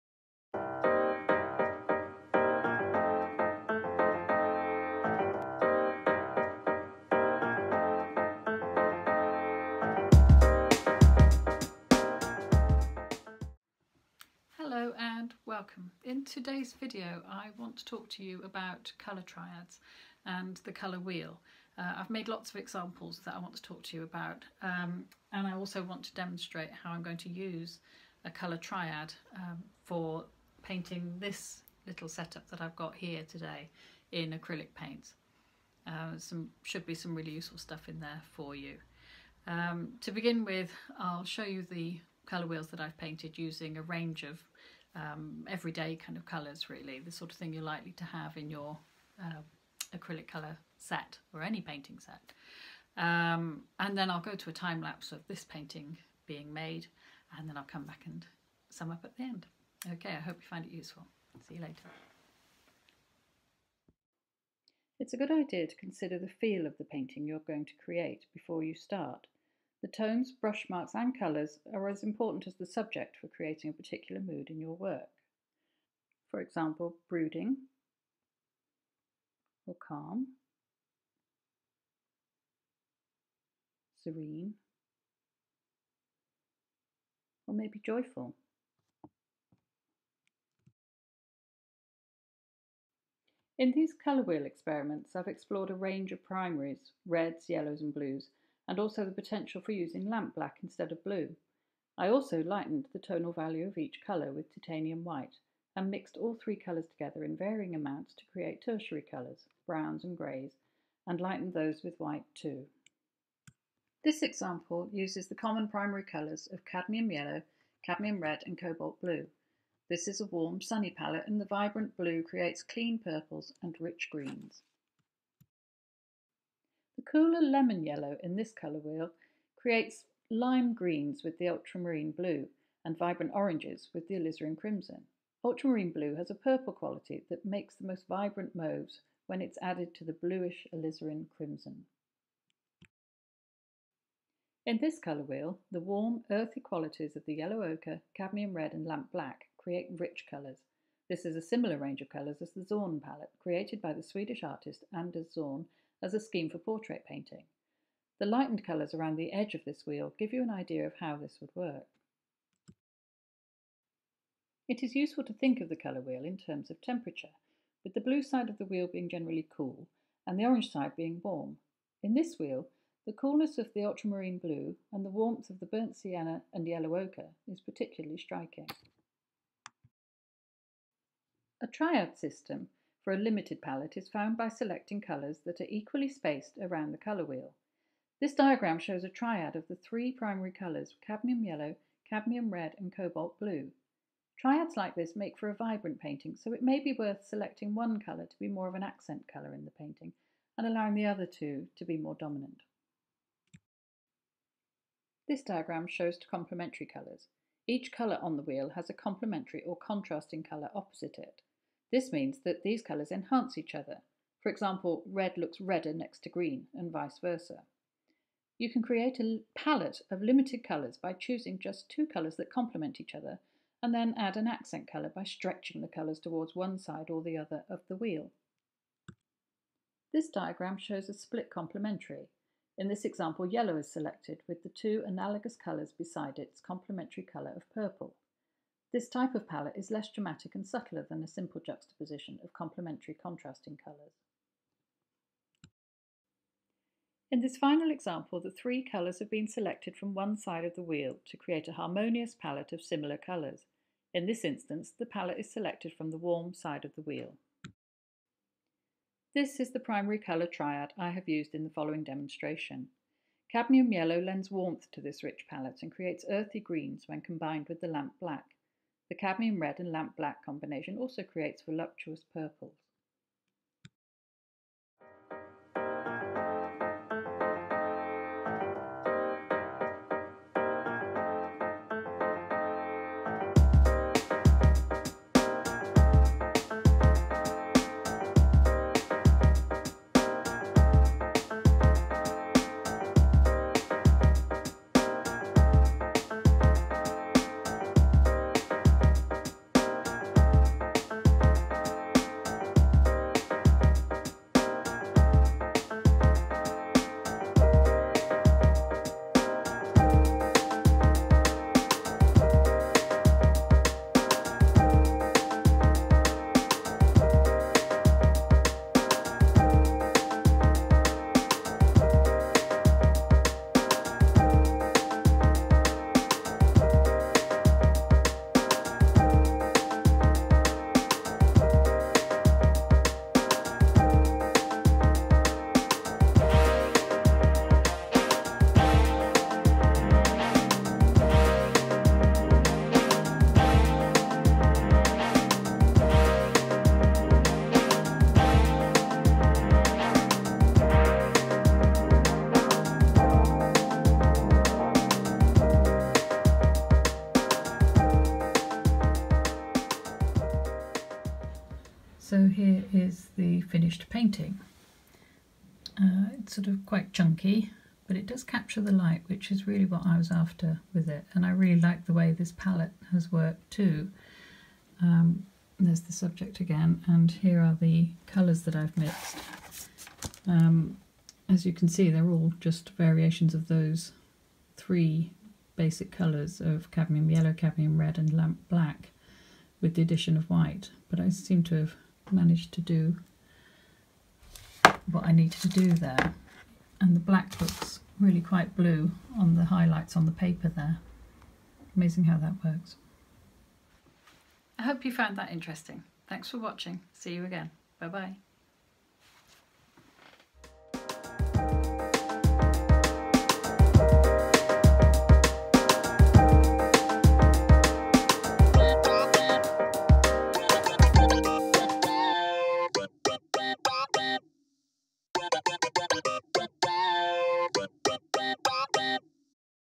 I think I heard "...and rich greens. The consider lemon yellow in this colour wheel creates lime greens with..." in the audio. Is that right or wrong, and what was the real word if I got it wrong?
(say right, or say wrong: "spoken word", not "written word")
wrong: "cooler", not "consider".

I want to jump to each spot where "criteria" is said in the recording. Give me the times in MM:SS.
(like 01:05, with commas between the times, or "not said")
not said.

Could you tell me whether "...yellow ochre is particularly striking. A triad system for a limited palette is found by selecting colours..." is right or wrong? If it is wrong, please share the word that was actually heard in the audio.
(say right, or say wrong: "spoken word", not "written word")
right.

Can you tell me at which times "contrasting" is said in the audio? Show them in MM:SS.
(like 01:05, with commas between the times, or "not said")
03:29, 04:03.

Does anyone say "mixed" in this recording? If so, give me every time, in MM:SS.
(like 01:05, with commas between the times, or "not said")
01:45, 06:18.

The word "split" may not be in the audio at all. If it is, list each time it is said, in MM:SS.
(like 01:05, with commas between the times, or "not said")
03:51.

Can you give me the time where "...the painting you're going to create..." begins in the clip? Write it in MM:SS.
01:06.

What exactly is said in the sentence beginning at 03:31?
This means that these colours enhance each other.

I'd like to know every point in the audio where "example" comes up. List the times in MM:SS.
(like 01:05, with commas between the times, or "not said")
00:22, 01:16, 01:54, 03:34, 03:53, 04:07.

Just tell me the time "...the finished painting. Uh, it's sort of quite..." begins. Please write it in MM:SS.
06:03.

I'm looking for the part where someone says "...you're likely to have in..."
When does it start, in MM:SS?
00:47.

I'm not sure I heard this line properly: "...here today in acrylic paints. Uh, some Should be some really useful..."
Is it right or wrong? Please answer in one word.
right.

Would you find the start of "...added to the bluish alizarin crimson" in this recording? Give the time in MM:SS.
02:19.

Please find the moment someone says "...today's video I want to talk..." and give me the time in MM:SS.
00:16.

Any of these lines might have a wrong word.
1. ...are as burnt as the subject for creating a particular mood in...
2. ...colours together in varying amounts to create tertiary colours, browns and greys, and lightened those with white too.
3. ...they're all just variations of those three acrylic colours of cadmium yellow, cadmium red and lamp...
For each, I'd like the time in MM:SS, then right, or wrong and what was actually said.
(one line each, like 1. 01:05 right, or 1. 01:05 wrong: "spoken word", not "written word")
1. 01:11 wrong: "important", not "burnt"
2. 01:46 right
3. 06:22 wrong: "basic", not "acrylic".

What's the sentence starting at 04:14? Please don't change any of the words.
In this instance, the palette is selected from the warm side of the wheel.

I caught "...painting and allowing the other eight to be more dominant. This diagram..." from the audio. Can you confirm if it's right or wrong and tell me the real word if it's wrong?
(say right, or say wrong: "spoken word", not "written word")
wrong: "two", not "eight".